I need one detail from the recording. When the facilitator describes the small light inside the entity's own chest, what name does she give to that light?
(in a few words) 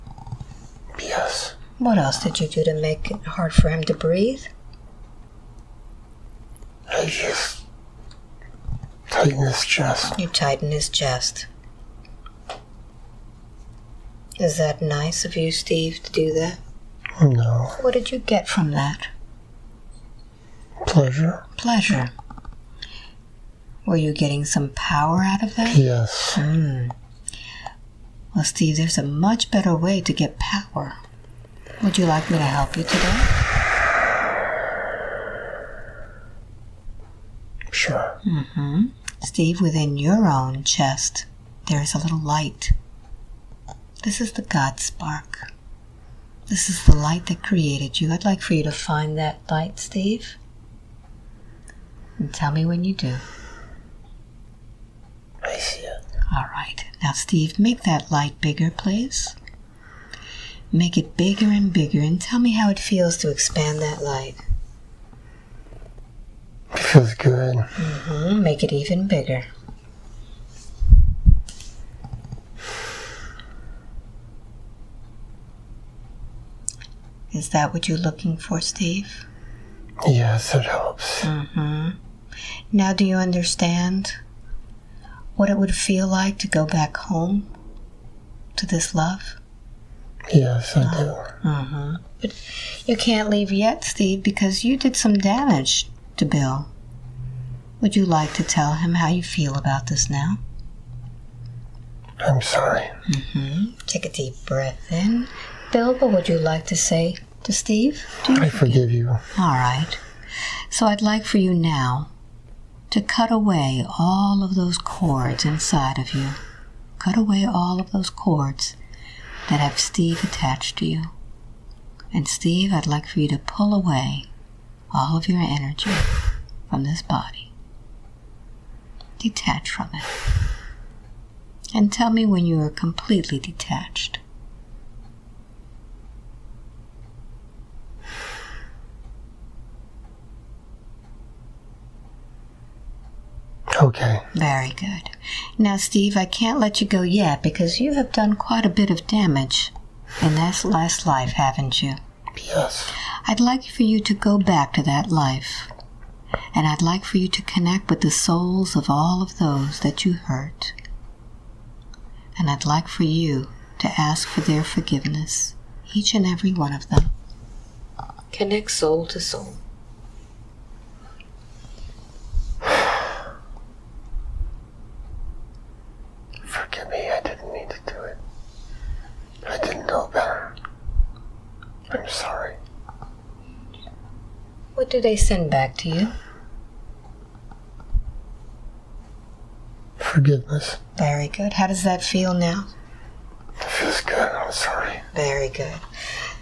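God spark.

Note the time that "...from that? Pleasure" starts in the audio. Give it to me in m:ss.
0:18.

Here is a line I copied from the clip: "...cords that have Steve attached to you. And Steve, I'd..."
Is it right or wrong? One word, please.
right.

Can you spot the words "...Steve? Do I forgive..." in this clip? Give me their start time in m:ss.
1:47.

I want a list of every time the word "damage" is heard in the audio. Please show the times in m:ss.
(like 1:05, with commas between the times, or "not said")
1:35, 2:29.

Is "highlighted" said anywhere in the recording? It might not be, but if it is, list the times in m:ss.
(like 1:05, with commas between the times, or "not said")
not said.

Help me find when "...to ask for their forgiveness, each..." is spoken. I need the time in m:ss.
2:43.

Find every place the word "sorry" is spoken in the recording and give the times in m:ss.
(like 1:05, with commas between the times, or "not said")
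1:42, 3:14.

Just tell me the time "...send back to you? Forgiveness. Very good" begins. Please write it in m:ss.
3:05.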